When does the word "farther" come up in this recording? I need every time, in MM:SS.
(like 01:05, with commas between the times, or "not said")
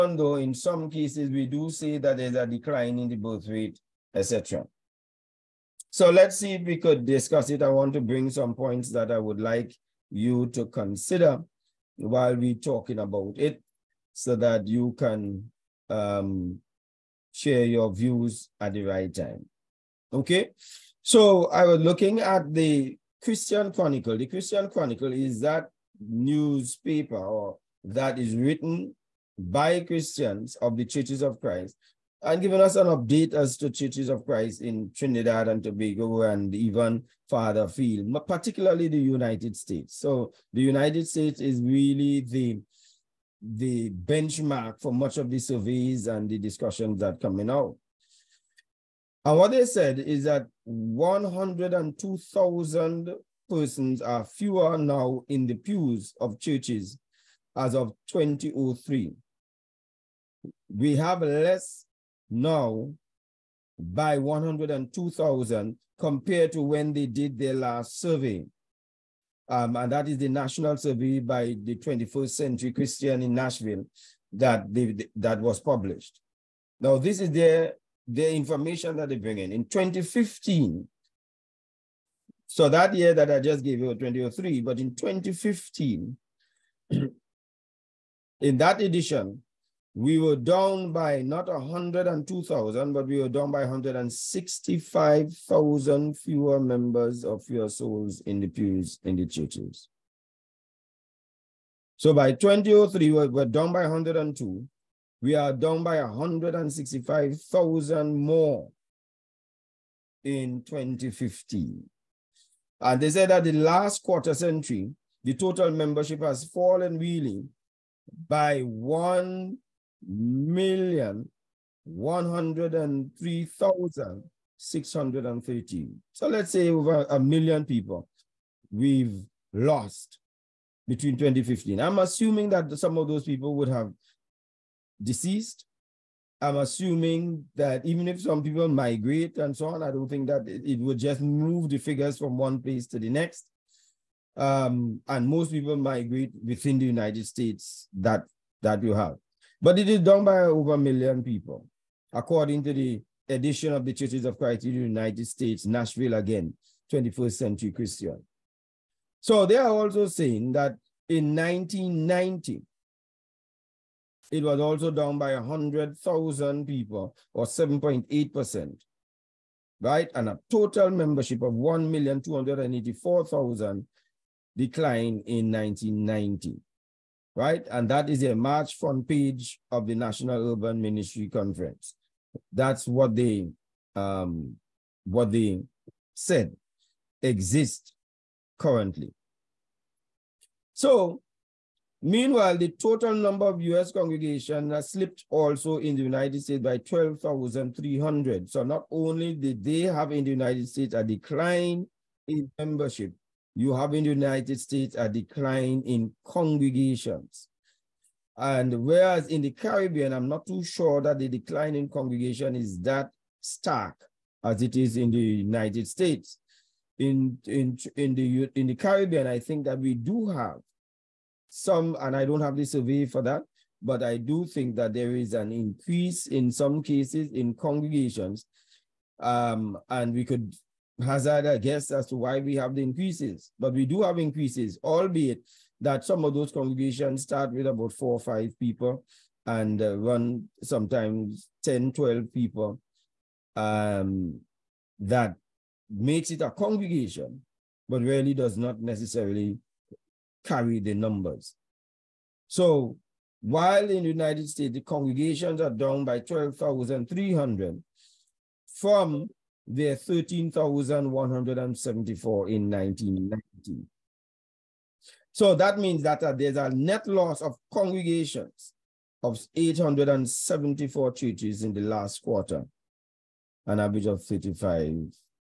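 00:37.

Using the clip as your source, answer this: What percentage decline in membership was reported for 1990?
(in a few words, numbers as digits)
7.8%.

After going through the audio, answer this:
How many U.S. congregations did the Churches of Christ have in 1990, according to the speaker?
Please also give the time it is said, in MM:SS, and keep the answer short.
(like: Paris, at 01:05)
13,174, at 04:19.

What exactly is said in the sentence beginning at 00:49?
And what they said is that 102,000 persons are fewer now in the pews of churches as of 2003.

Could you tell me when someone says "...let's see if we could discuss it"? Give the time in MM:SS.
00:06.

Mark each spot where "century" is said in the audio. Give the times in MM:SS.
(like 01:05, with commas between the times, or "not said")
01:12, 01:54, 02:37.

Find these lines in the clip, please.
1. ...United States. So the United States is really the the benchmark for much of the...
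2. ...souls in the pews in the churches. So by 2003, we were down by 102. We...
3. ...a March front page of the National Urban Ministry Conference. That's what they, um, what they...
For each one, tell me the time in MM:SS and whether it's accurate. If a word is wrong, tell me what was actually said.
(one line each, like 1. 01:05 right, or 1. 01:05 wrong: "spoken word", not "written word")
1. 00:38 right
2. 01:37 right
3. 02:58 right.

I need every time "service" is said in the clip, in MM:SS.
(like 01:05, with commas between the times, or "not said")
not said.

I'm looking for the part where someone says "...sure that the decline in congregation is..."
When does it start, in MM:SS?
03:30.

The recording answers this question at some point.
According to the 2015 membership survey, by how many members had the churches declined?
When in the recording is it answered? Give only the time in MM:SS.
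01:33.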